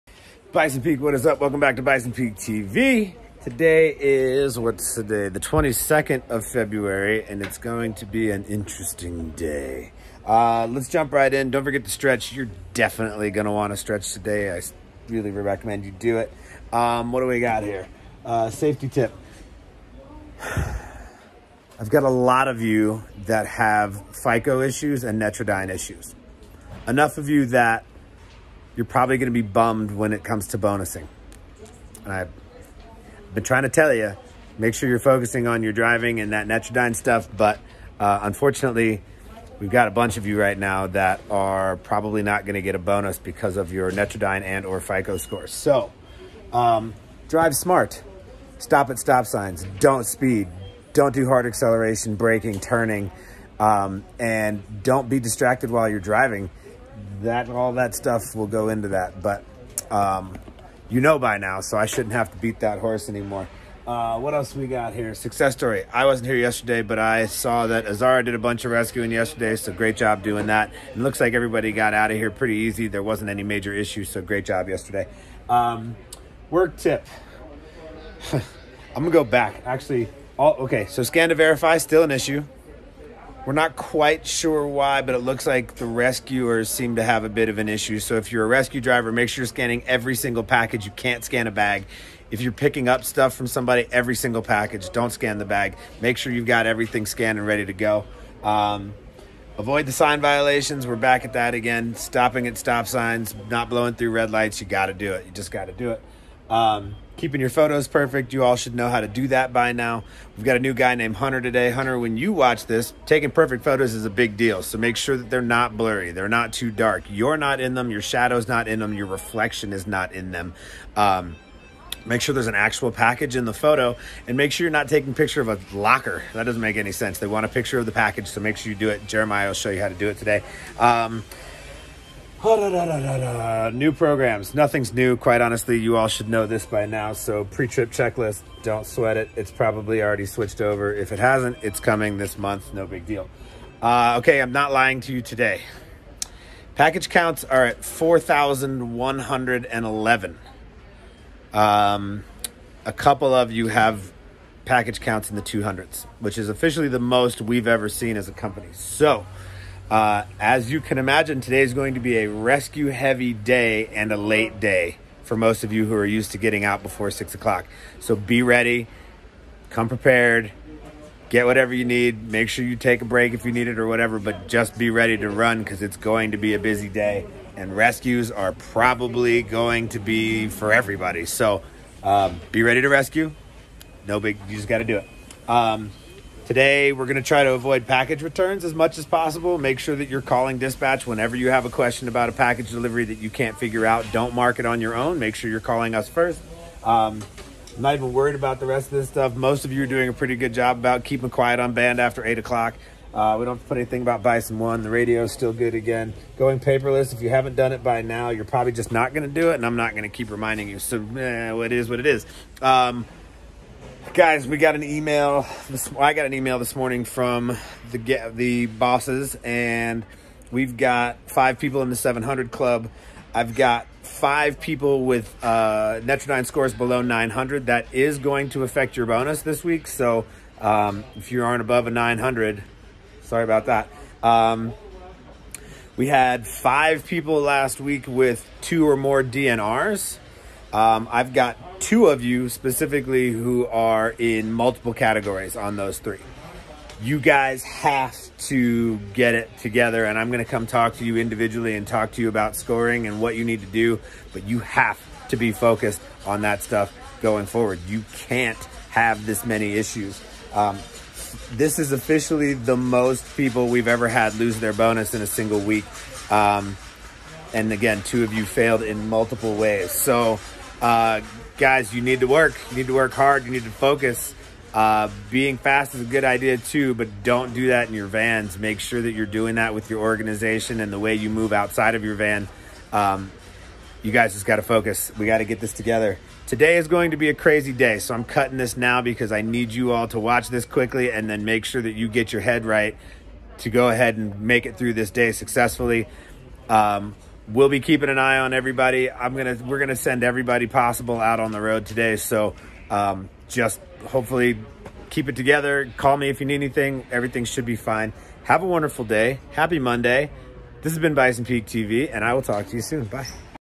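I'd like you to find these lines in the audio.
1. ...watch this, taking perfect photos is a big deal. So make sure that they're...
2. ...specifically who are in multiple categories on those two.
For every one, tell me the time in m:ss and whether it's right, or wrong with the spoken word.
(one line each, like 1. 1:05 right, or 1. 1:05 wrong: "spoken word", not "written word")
1. 1:52 right
2. 4:02 wrong: "three", not "two".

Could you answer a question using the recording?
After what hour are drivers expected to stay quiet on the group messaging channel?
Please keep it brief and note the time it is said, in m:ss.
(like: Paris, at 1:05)
8 o'clock, at 3:22.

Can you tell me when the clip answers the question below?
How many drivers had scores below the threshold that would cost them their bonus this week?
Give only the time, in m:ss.
3:44.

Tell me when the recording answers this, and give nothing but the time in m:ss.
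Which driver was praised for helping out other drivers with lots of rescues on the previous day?
1:07.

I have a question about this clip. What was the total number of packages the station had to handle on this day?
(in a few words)
4,111.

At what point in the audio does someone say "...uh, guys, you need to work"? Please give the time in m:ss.
4:30.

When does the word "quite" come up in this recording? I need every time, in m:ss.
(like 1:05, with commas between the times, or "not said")
1:23, 2:15.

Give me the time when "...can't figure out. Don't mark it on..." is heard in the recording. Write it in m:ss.
3:13.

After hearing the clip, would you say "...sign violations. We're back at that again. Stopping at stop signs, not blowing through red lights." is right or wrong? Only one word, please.
right.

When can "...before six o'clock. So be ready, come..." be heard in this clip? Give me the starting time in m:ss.
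2:46.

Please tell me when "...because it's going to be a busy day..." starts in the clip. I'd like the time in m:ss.
2:55.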